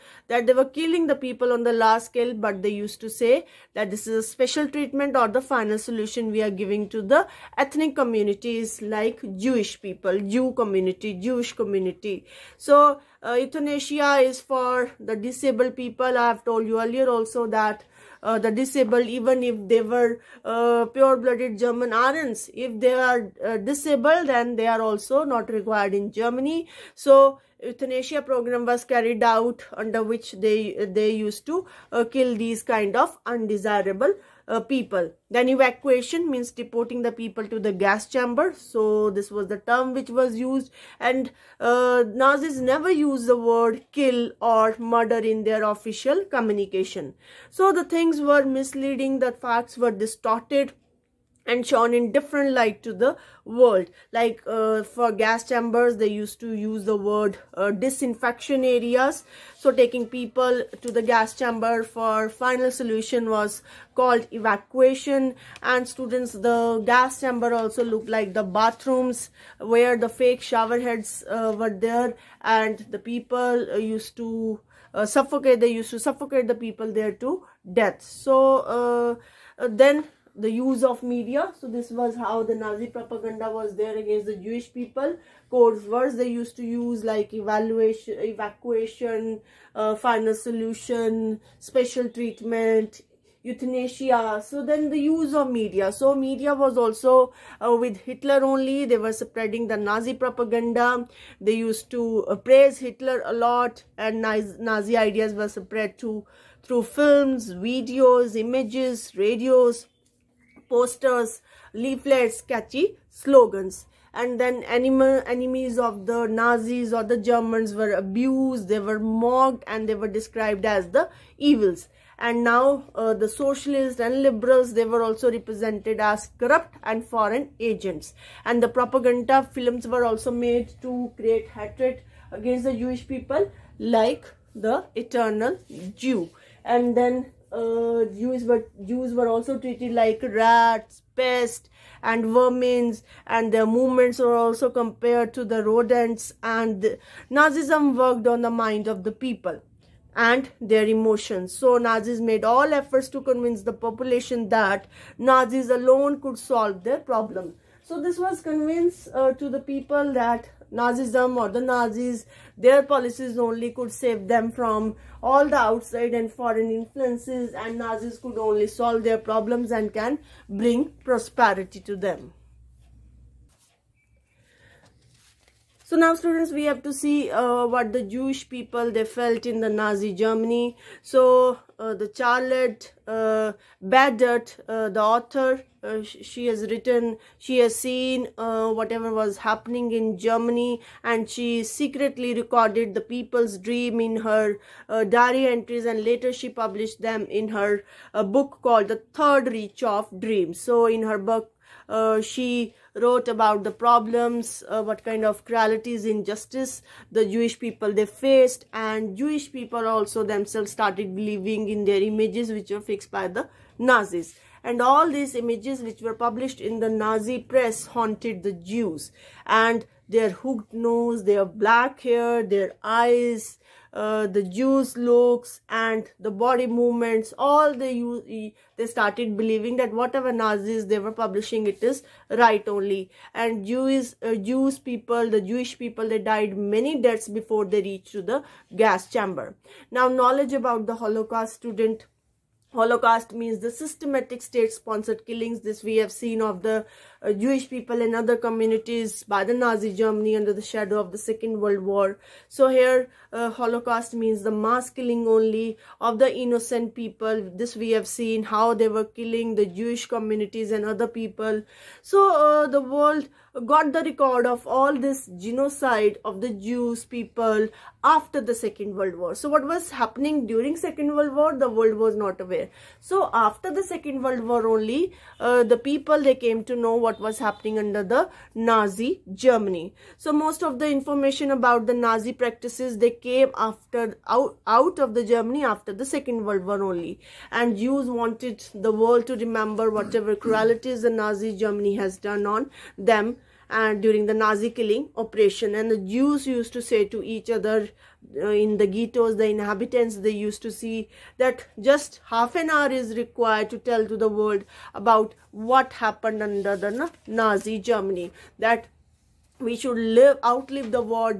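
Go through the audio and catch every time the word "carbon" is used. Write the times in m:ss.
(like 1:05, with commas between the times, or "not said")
not said.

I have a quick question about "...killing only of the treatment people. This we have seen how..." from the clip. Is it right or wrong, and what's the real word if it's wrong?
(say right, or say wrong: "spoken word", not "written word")
wrong: "innocent", not "treatment".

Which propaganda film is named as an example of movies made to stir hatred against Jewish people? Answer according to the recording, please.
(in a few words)
The Eternal Jew.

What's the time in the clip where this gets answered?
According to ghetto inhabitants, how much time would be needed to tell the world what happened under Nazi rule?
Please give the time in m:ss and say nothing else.
5:02.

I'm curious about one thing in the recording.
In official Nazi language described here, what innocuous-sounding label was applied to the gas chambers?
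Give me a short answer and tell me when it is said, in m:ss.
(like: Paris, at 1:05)
Disinfection areas, at 0:57.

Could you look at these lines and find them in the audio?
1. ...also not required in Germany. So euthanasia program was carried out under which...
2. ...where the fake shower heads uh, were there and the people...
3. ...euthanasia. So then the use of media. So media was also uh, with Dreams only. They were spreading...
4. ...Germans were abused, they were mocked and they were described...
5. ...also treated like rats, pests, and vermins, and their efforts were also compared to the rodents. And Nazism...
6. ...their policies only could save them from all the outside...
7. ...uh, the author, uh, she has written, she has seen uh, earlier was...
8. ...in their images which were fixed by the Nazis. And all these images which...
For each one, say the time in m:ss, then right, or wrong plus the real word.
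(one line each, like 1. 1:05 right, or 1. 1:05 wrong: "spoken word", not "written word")
1. 0:24 right
2. 1:09 right
3. 1:33 wrong: "Hitler", not "Dreams"
4. 1:57 right
5. 2:19 wrong: "movements", not "efforts"
6. 2:42 right
7. 3:04 wrong: "whatever", not "earlier"
8. 3:31 right.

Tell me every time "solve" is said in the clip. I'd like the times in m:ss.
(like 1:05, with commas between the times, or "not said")
2:36, 2:48.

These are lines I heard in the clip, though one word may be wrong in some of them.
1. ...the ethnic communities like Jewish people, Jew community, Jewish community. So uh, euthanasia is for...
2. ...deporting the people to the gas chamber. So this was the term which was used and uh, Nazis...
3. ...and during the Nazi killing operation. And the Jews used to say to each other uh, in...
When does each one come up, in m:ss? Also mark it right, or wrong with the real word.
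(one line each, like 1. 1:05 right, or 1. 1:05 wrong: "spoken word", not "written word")
1. 0:06 right
2. 0:36 right
3. 4:53 right.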